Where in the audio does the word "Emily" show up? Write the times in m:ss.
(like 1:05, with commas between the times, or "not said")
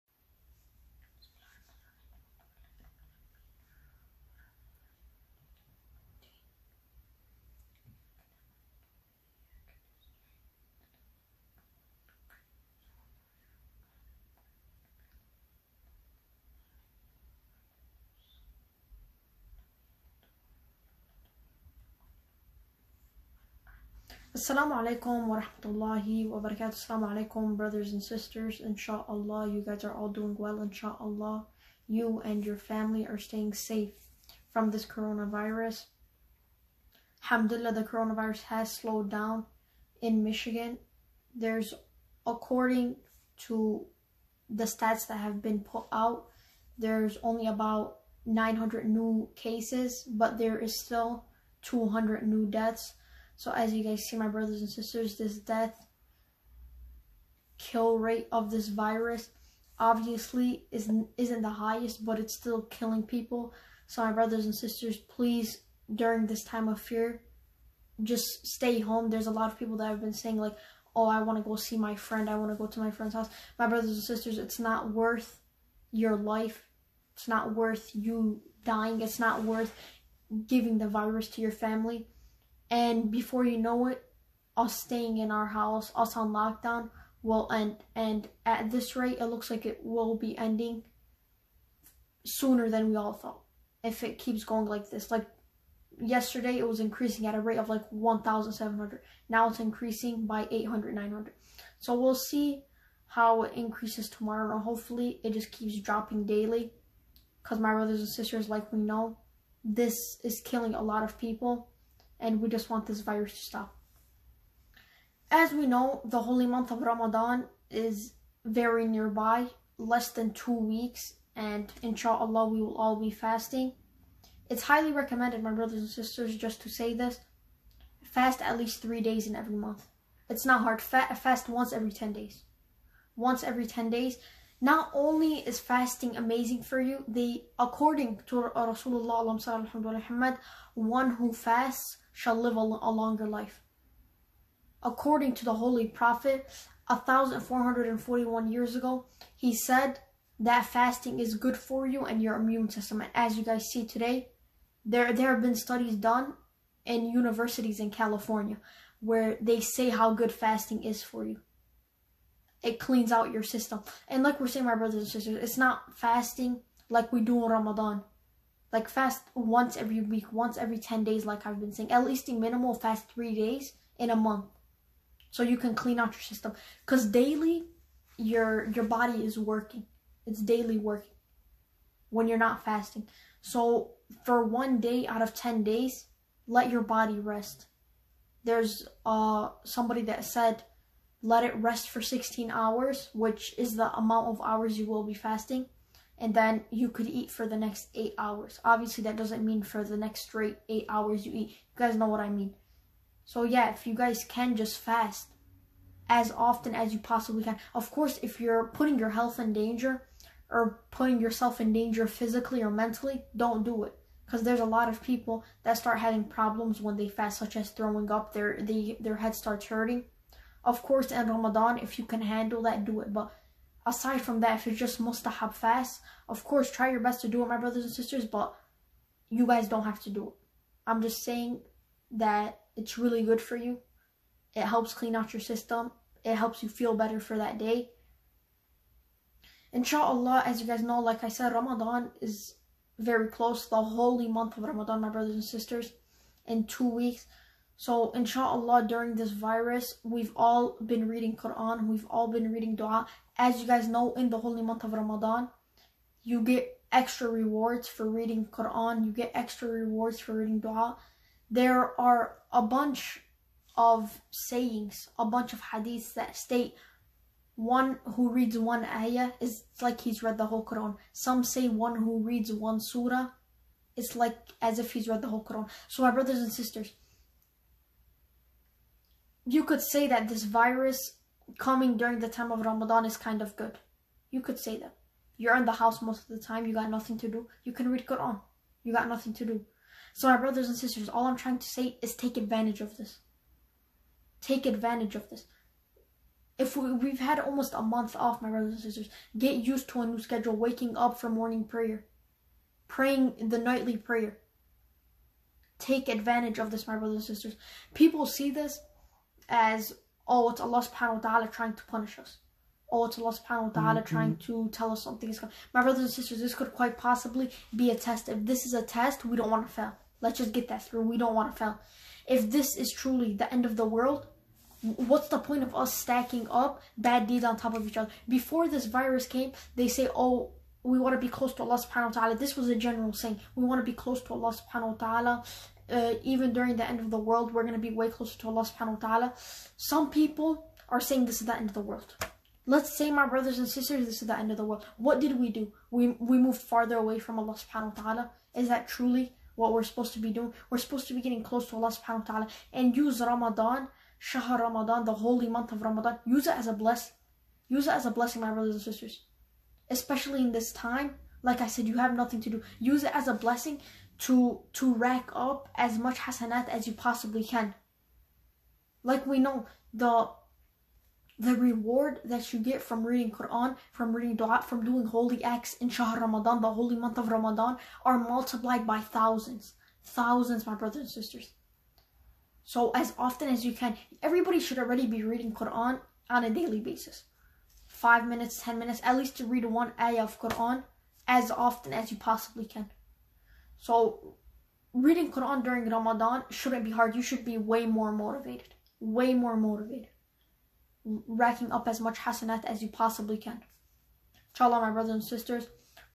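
not said.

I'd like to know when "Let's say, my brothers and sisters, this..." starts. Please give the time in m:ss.
5:42.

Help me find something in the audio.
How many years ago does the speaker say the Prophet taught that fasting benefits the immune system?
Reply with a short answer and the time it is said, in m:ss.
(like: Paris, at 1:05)
1,441, at 2:26.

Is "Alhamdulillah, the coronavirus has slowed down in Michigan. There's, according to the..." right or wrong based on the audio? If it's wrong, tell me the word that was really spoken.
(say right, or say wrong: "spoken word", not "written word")
right.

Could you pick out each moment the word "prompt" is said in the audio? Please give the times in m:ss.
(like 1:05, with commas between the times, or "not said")
not said.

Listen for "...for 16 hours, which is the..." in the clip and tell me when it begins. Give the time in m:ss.
3:11.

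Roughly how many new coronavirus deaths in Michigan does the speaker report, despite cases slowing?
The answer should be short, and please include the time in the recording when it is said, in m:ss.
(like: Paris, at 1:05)
200, at 0:51.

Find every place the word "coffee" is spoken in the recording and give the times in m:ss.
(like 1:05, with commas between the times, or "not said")
not said.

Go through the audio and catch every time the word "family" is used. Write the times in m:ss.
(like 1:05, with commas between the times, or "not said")
0:32, 1:21.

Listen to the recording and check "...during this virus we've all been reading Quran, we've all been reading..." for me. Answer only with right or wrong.
right.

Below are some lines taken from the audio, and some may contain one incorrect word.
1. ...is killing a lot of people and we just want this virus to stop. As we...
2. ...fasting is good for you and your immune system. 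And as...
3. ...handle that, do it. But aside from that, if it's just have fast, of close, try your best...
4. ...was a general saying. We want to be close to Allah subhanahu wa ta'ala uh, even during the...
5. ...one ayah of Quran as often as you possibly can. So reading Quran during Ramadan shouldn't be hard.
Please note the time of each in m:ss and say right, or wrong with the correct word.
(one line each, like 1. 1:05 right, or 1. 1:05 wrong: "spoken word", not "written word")
1. 1:50 right
2. 2:30 right
3. 3:42 wrong: "course", not "close"
4. 5:32 right
5. 6:29 right.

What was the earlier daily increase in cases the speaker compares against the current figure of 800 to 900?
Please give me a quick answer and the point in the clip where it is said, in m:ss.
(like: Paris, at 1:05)
1,700, at 1:37.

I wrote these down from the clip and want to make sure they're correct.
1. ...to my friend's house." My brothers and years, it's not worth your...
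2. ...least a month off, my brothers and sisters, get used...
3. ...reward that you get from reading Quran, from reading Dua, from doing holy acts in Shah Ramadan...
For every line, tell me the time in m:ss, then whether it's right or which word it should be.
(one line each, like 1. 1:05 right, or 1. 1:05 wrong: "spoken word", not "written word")
1. 1:12 wrong: "sisters", not "years"
2. 4:57 wrong: "almost", not "least"
3. 6:11 right.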